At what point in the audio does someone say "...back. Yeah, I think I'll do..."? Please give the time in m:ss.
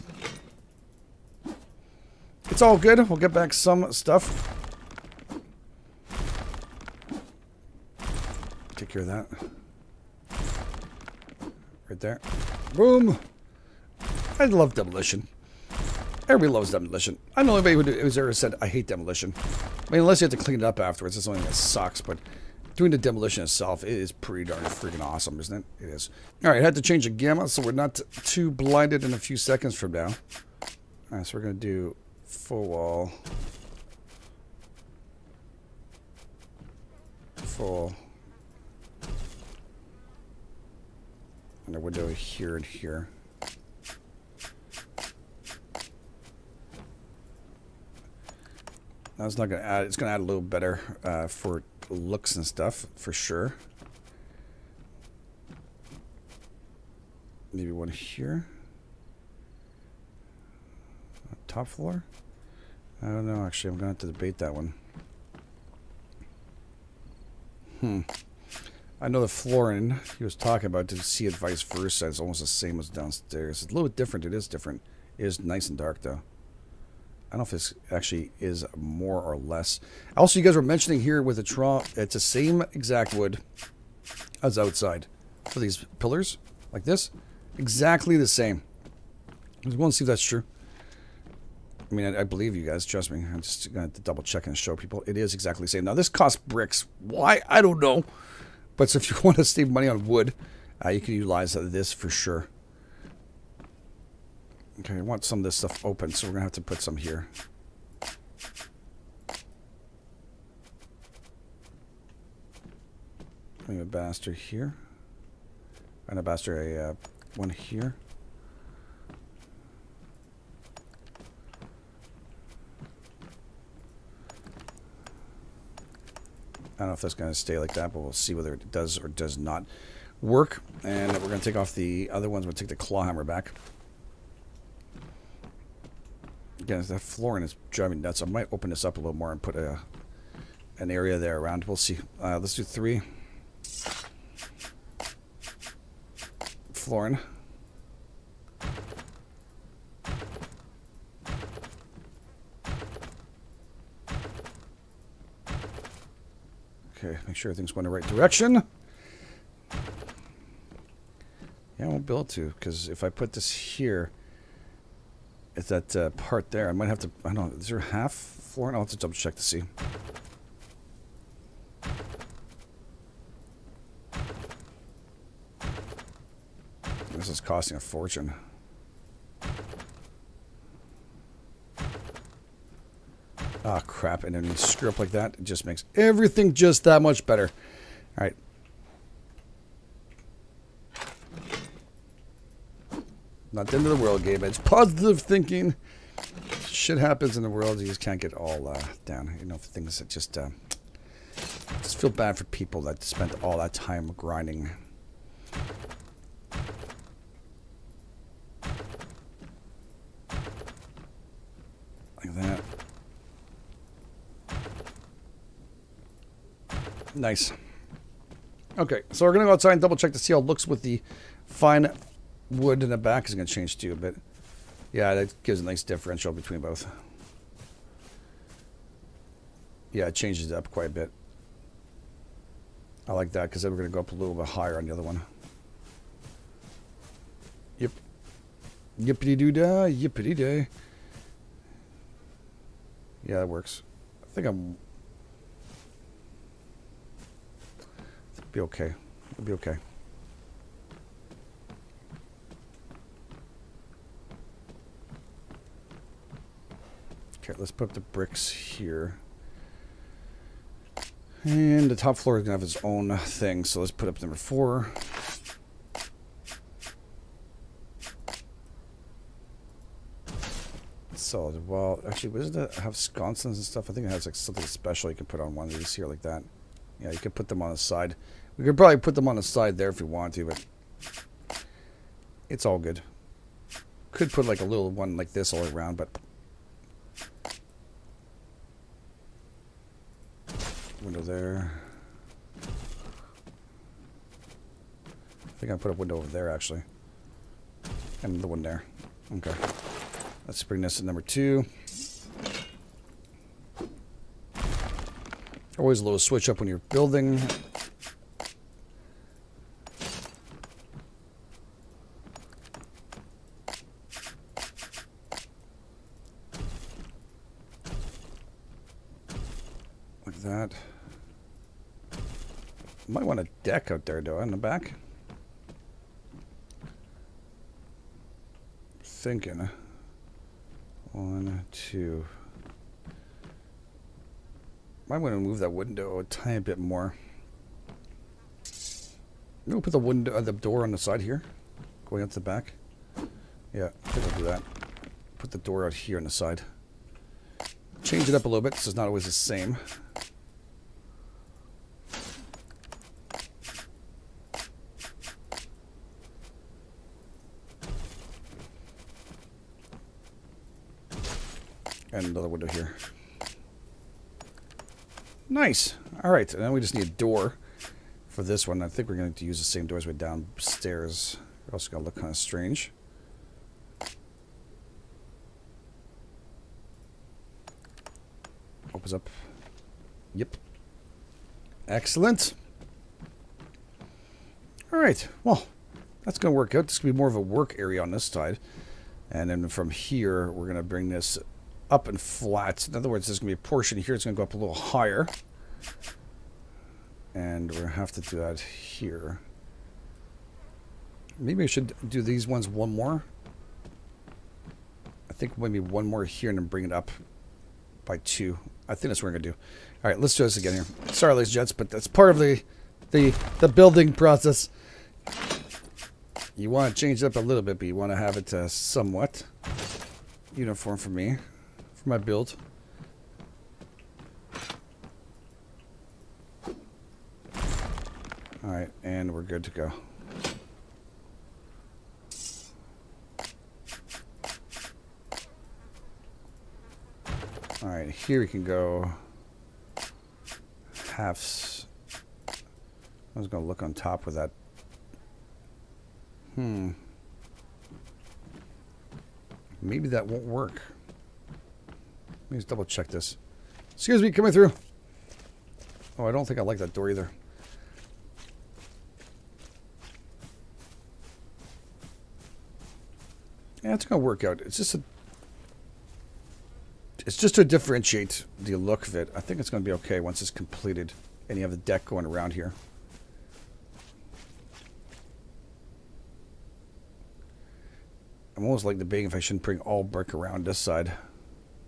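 5:42.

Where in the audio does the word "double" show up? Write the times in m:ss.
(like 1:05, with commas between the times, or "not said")
1:33, 2:48, 3:39, 7:32.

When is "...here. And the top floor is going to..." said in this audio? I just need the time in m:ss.
4:18.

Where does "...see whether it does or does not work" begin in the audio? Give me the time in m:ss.
2:08.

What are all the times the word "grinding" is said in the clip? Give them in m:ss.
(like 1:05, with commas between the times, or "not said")
3:24.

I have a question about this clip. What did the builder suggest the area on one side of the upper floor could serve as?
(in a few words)
A work area.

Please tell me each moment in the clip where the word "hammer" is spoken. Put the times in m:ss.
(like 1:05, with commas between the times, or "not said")
2:13.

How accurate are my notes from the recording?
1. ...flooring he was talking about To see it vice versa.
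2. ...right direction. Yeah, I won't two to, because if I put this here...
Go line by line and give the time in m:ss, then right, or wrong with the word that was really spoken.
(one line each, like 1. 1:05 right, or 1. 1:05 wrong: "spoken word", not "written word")
1. 1:09 right
2. 2:37 right.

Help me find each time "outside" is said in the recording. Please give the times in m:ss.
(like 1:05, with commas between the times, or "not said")
1:24, 3:39.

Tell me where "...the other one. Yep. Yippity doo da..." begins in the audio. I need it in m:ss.
3:54.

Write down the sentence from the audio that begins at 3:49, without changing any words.
Yeah, it changes it up quite a bit.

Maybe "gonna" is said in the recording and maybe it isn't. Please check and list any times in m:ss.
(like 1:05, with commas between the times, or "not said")
5:39, 7:44.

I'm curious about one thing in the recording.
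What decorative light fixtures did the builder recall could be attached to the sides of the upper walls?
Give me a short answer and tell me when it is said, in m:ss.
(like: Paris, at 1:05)
Sconces, at 4:32.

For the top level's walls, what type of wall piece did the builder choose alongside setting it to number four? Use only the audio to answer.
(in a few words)
Solid wall.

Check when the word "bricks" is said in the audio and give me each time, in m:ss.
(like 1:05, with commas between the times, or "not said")
1:36, 4:17, 8:00.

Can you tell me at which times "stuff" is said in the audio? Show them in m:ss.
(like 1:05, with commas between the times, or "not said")
0:03, 0:52, 1:45, 4:33.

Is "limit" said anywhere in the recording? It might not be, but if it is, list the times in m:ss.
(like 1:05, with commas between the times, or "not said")
not said.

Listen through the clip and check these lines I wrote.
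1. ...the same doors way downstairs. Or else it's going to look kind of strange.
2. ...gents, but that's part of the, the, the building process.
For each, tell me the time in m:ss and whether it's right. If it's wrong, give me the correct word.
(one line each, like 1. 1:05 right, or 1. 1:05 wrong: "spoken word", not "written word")
1. 6:09 right
2. 6:51 right.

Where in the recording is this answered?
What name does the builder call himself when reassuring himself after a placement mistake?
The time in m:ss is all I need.
3:14.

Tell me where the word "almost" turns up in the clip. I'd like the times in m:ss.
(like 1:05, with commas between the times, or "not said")
1:12, 7:58.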